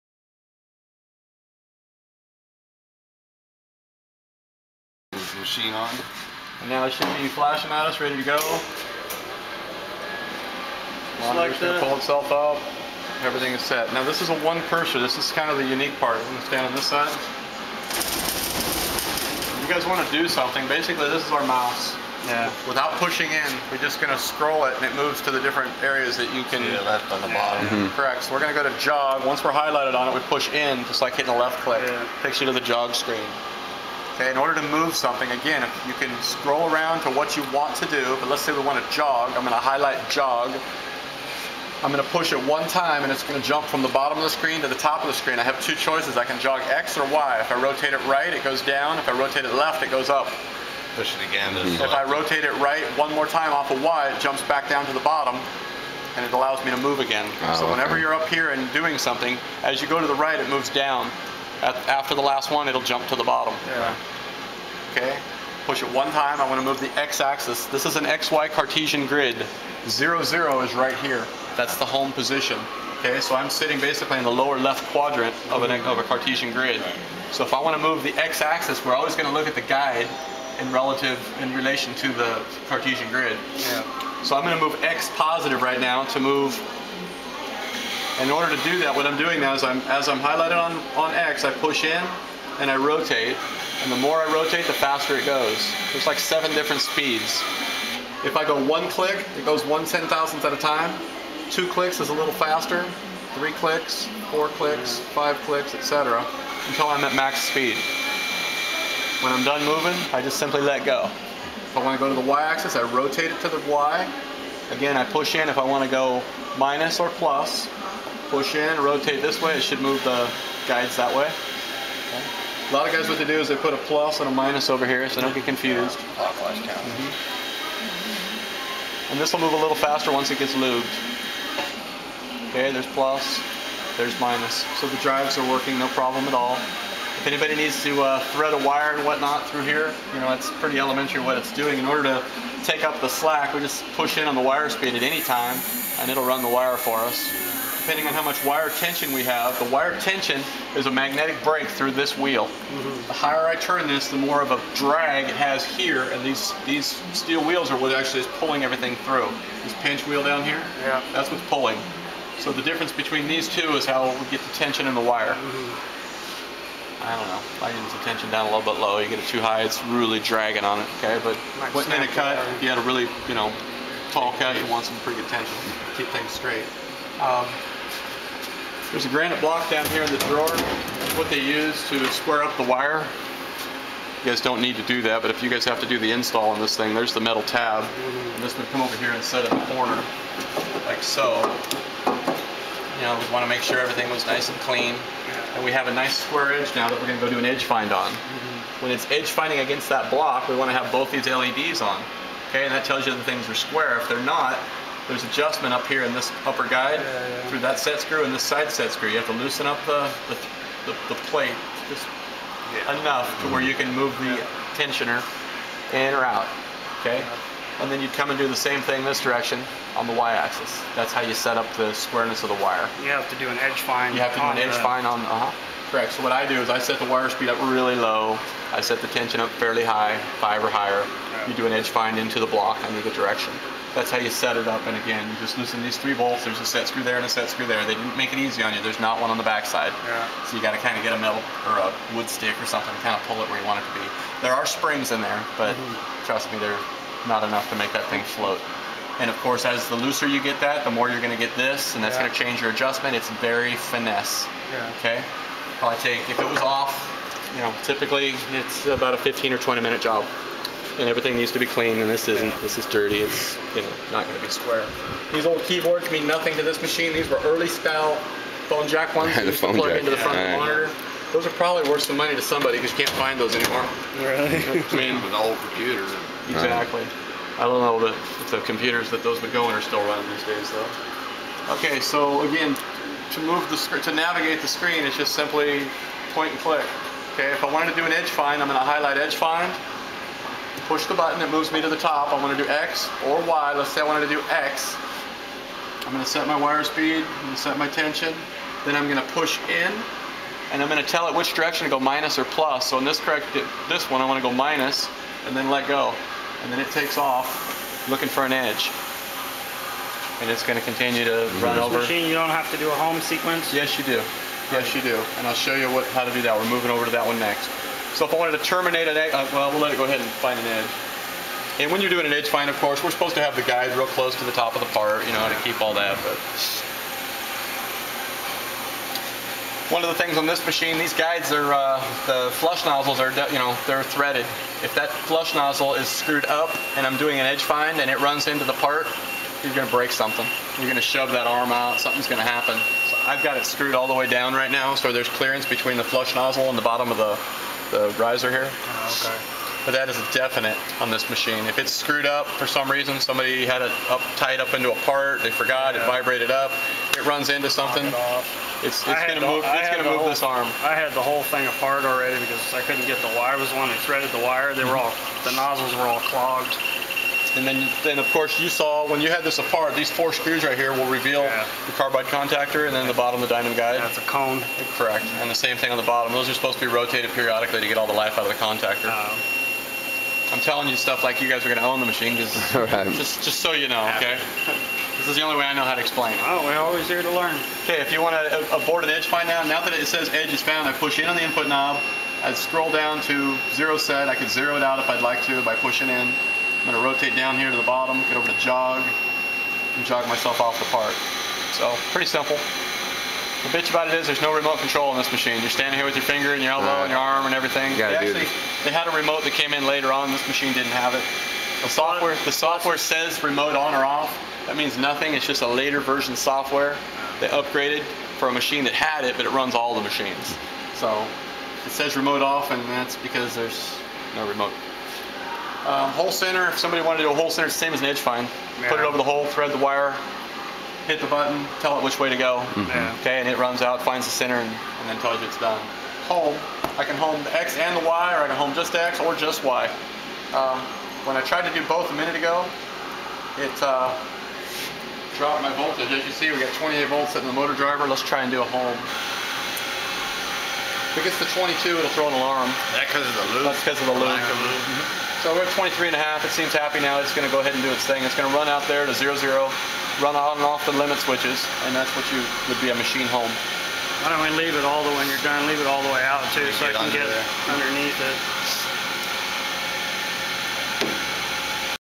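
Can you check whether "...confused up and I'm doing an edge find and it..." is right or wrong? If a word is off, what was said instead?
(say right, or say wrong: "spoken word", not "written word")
wrong: "screwed", not "confused".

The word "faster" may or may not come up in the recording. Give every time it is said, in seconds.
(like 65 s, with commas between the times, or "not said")
94 s, 102 s, 129 s.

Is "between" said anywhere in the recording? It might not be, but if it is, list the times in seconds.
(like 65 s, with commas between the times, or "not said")
162 s, 345 s.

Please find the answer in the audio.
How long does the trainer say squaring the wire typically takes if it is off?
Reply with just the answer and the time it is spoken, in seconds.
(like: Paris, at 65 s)
15 or 20 minutes, at 259 s.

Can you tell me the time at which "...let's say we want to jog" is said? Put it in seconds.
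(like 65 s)
38 s.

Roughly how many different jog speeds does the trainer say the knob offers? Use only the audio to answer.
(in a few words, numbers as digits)
7.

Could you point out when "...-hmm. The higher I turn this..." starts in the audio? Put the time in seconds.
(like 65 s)
152 s.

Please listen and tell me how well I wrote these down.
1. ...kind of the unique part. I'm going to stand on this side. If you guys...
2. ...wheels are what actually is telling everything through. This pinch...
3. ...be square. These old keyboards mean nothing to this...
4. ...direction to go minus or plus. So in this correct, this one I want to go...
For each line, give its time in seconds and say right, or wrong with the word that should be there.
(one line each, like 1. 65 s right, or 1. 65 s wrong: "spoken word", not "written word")
1. 15 s right
2. 157 s wrong: "pulling", not "telling"
3. 264 s right
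4. 301 s right.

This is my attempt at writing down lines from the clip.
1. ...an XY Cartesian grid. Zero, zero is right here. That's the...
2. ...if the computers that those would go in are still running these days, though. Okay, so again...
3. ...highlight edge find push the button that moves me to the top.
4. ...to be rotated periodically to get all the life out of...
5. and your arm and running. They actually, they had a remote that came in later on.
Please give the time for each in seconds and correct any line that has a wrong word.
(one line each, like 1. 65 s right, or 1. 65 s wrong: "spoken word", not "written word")
1. 67 s right
2. 278 s right
3. 288 s right
4. 376 s right
5. 407 s wrong: "everything", not "running".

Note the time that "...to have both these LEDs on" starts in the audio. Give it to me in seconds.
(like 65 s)
200 s.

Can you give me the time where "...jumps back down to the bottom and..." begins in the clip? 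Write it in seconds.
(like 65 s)
54 s.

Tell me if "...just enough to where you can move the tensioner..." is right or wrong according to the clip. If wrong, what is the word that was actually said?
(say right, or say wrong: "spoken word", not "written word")
right.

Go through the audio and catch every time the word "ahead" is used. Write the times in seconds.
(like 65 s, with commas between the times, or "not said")
320 s, 457 s.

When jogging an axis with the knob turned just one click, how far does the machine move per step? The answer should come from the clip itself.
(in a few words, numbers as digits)
1 ten-thousandth.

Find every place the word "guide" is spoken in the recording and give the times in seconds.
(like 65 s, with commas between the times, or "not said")
79 s, 120 s, 206 s, 323 s, 331 s, 373 s.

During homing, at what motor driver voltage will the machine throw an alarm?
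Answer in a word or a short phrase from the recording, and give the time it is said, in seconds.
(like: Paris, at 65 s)
22, at 451 s.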